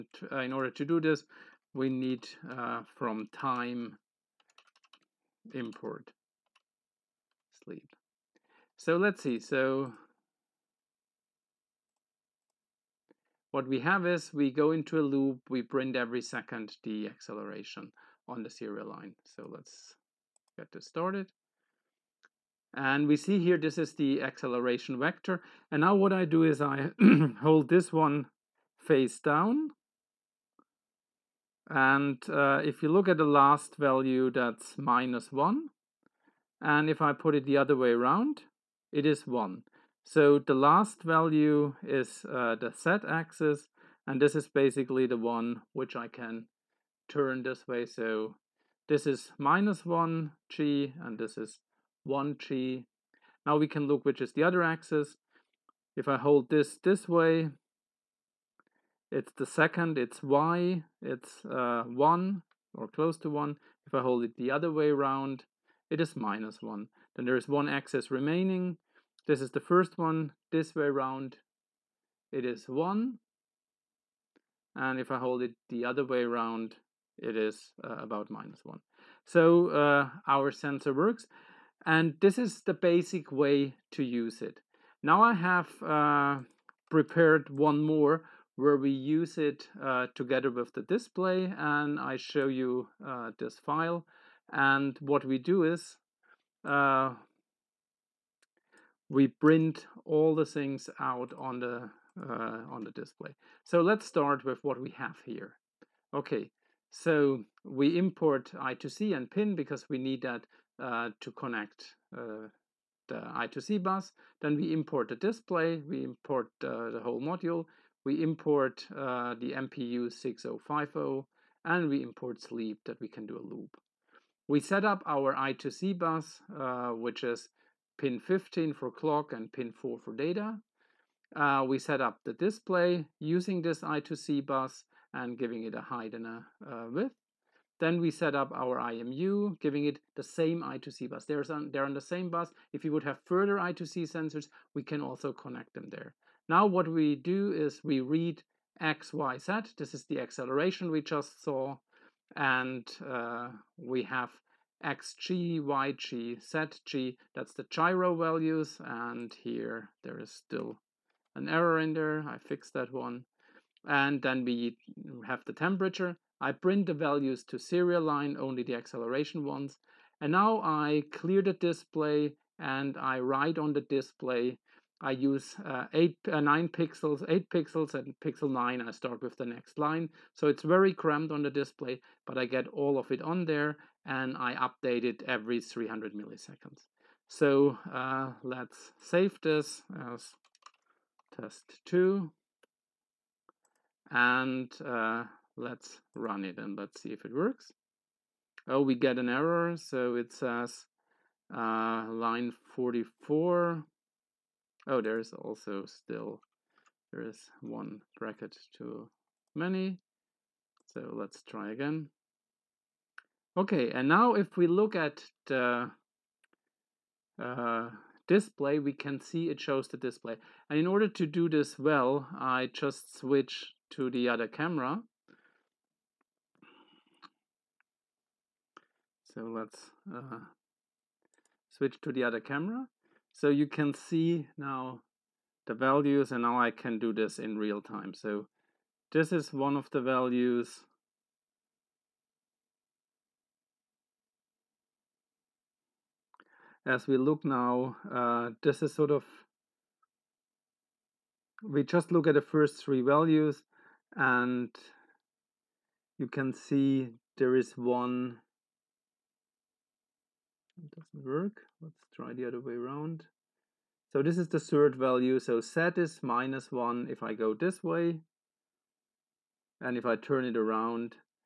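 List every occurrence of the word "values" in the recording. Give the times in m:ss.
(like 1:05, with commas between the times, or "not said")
0:33, 0:41, 2:38, 2:46, 3:55, 4:00, 4:13, 4:24.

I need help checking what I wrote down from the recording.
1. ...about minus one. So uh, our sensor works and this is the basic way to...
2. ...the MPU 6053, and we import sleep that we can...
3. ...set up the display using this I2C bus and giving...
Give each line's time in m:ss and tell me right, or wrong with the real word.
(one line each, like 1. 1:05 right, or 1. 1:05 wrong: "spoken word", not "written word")
1. 1:17 right
2. 1:59 wrong: "6050", not "6053"
3. 2:11 right.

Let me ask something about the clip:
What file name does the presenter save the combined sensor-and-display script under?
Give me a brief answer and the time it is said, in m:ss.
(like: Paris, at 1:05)
test 2, at 3:11.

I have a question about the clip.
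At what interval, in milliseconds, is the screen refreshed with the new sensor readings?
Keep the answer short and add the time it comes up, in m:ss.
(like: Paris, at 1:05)
300, at 3:05.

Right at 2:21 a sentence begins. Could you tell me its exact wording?
They're on, they're on the same bus.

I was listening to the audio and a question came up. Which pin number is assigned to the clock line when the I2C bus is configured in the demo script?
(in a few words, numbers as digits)
15.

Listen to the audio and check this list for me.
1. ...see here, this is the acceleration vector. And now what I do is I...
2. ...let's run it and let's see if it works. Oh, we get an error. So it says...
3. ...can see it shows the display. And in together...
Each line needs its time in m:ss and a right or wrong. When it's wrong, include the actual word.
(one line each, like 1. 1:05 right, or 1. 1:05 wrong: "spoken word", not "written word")
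1. 0:23 right
2. 3:15 right
3. 3:38 wrong: "order", not "together".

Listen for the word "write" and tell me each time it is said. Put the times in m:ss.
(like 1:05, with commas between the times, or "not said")
2:53.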